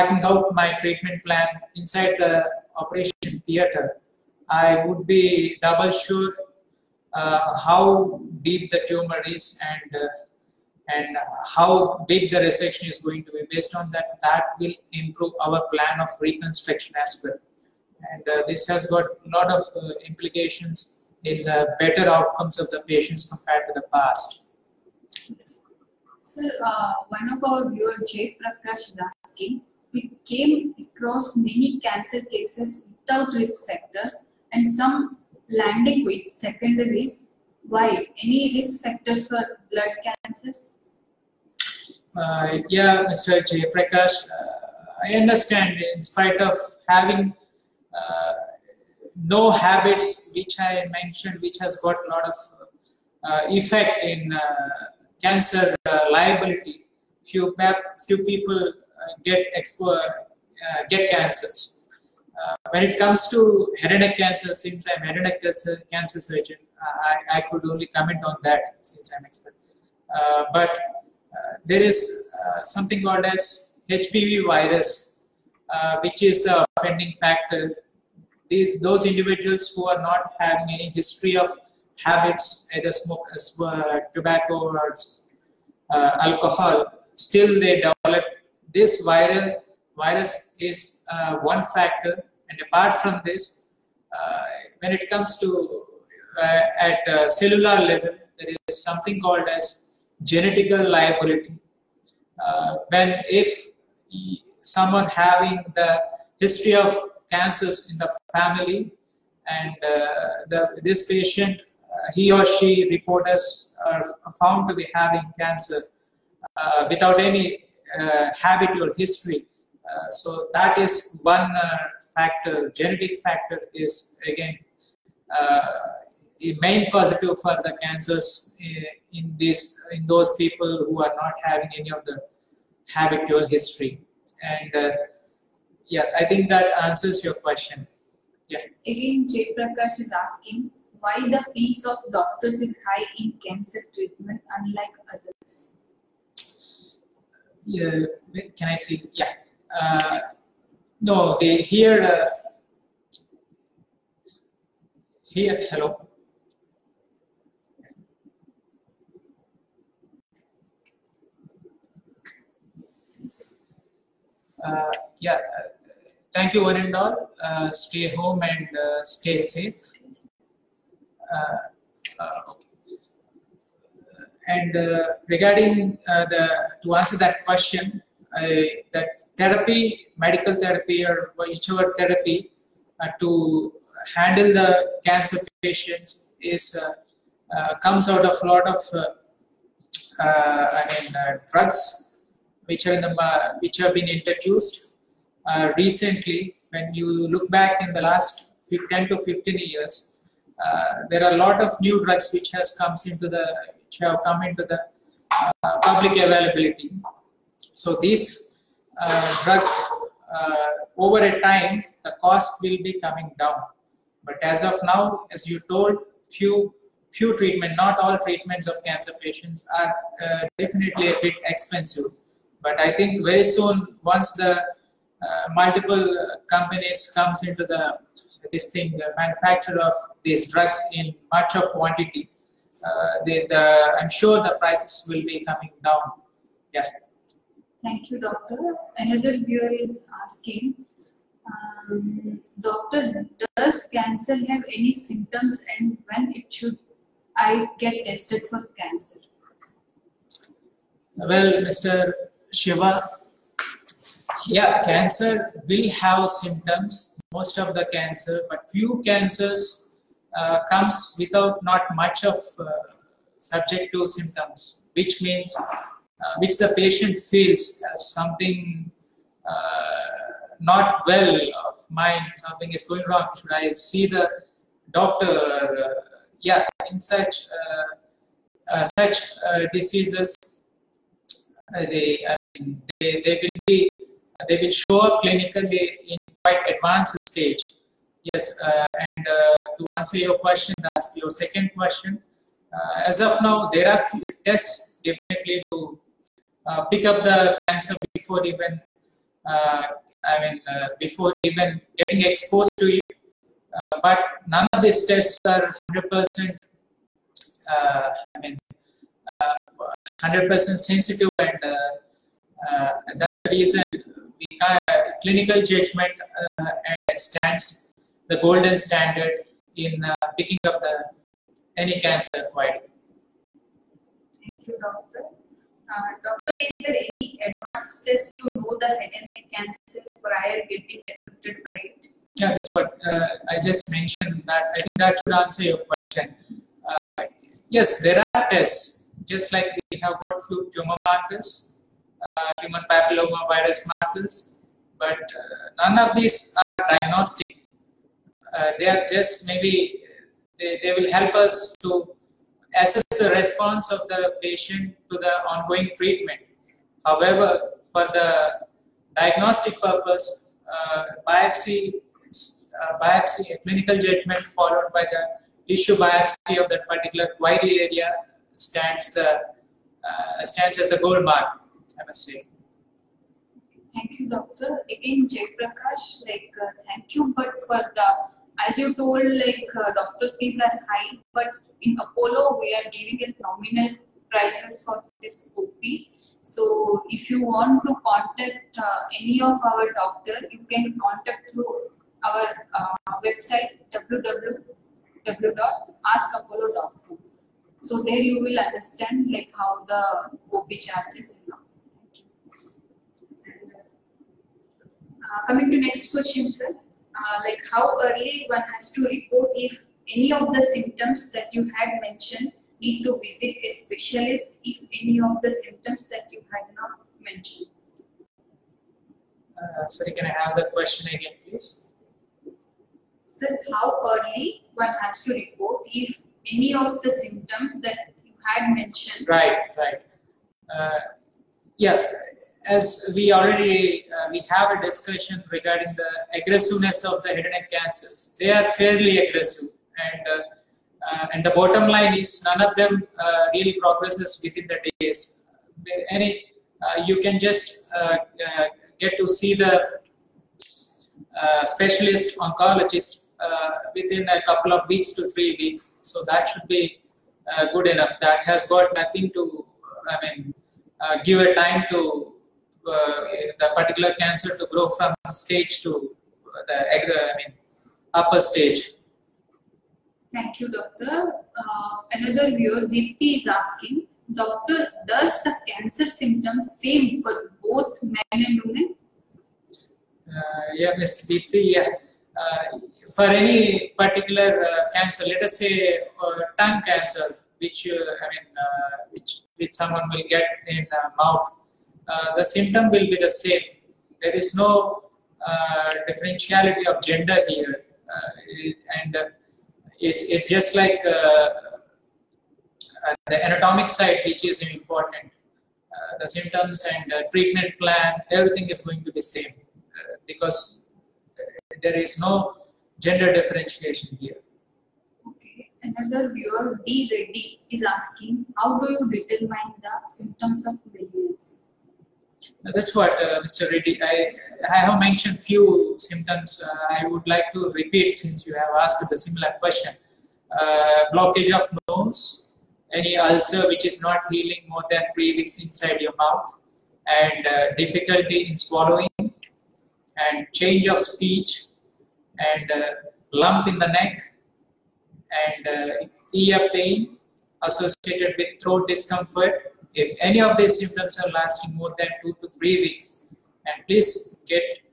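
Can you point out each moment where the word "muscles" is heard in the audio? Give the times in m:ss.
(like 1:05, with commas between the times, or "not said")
not said.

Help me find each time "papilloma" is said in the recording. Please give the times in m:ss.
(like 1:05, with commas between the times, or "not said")
5:42.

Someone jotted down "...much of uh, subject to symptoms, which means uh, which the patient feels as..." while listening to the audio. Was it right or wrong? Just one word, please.
right.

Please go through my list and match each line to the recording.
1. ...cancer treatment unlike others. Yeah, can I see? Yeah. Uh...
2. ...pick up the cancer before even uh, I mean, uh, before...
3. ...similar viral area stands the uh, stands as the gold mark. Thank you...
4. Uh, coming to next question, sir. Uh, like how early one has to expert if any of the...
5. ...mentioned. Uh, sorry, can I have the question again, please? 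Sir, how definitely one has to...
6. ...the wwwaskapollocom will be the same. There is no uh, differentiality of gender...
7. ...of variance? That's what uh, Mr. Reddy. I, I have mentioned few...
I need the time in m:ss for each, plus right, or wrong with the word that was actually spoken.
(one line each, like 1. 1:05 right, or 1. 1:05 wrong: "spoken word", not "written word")
1. 2:23 right
2. 4:56 right
3. 6:06 wrong: "particular", not "similar"
4. 6:45 wrong: "report", not "expert"
5. 6:57 wrong: "early", not "definitely"
6. 8:12 wrong: "symptom", not "wwwaskapollocom"
7. 8:40 right.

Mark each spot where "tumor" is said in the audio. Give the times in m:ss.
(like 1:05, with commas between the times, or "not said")
0:08, 5:40.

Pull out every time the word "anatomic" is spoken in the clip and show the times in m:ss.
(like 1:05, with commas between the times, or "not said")
8:23.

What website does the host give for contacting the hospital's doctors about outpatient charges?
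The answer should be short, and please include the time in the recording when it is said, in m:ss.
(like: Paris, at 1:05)
www.askapollo.com, at 6:33.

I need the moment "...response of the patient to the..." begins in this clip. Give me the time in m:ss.
5:53.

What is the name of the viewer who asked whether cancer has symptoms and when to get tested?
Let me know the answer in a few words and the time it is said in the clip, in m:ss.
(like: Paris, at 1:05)
Shiva, at 4:12.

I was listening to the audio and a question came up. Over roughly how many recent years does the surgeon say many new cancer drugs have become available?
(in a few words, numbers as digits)
10 to 15 years.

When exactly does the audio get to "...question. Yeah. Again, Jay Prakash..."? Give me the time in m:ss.
2:17.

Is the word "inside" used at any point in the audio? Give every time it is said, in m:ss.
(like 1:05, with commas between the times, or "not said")
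0:01, 8:55.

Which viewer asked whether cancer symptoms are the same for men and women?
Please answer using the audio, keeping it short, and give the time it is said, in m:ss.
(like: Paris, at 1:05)
Deepti, at 7:52.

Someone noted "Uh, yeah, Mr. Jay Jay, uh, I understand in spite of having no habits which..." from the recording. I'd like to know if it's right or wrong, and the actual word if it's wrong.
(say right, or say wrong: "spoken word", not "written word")
wrong: "Prakash", not "Jay".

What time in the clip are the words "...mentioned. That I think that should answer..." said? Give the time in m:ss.
5:33.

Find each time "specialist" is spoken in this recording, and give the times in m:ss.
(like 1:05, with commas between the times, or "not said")
6:53, 7:31.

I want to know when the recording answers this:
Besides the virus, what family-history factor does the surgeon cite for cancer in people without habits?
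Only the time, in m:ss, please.
1:40.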